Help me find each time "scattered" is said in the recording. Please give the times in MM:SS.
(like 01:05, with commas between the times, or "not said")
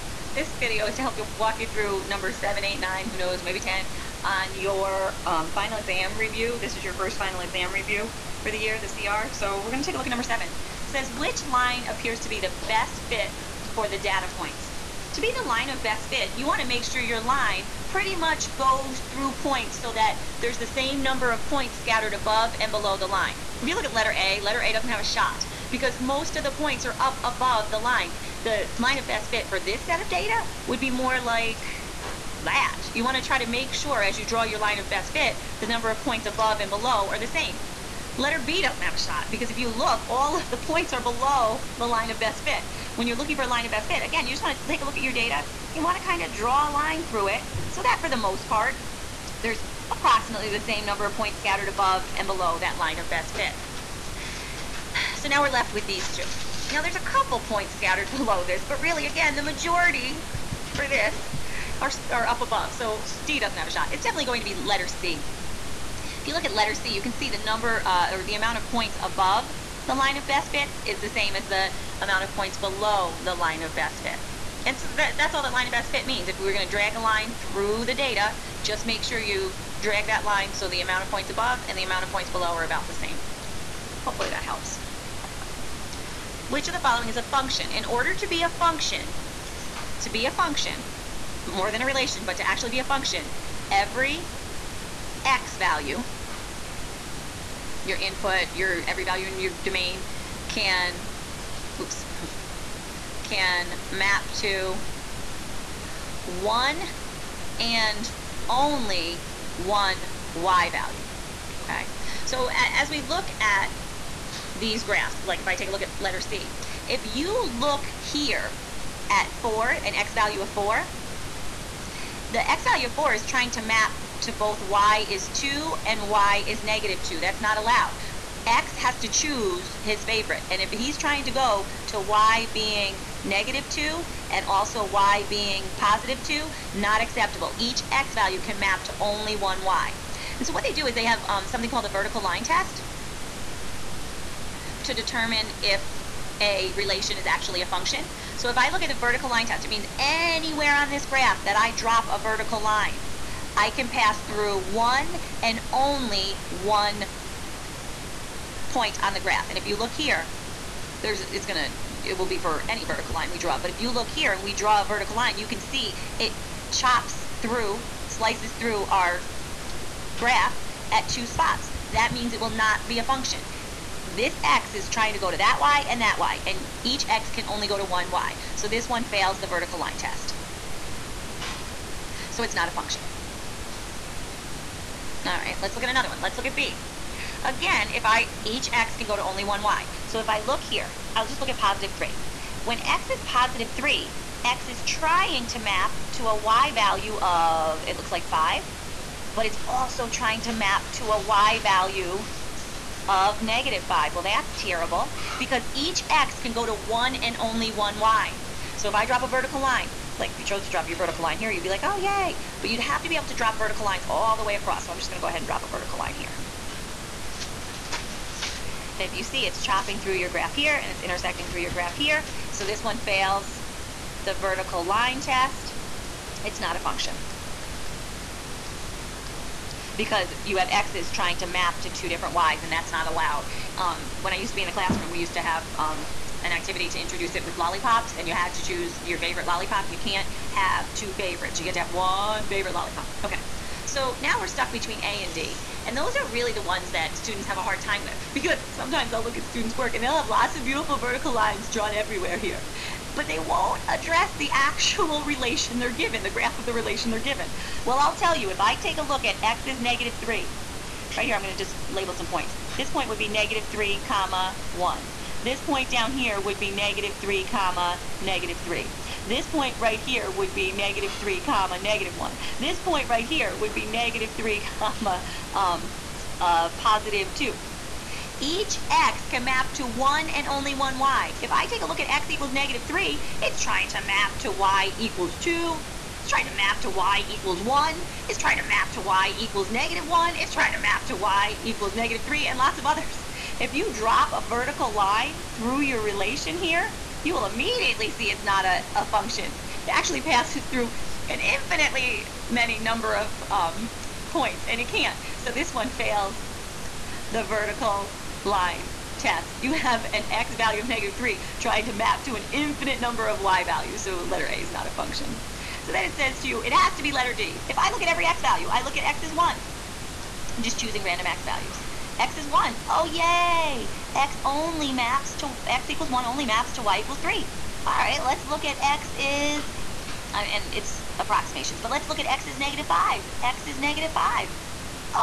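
00:21, 00:51, 00:57.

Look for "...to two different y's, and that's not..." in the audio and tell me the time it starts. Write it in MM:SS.
03:51.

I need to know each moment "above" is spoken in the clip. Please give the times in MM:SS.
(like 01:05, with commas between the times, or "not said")
00:22, 00:27, 00:36, 00:51, 01:02, 01:09, 01:21.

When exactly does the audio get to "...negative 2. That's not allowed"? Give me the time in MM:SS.
02:06.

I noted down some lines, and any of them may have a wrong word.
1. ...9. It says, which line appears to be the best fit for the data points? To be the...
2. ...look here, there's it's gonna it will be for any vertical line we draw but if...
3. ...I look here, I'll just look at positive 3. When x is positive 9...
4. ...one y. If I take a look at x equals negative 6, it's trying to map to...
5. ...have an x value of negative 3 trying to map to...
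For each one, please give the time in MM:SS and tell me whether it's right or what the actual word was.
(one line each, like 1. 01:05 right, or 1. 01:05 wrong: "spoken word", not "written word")
1. 00:10 wrong: "7", not "9"
2. 02:39 right
3. 03:10 wrong: "3", not "9"
4. 04:40 wrong: "3", not "6"
5. 05:09 right.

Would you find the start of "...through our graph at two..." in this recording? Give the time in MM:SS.
02:48.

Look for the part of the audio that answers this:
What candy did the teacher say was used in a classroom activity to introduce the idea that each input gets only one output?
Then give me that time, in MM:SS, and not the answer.
03:57.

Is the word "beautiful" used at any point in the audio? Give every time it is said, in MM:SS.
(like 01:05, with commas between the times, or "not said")
04:10.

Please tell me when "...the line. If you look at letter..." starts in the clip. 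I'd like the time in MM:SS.
00:22.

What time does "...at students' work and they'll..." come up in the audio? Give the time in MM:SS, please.
04:09.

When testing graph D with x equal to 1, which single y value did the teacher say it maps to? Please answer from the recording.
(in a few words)
3.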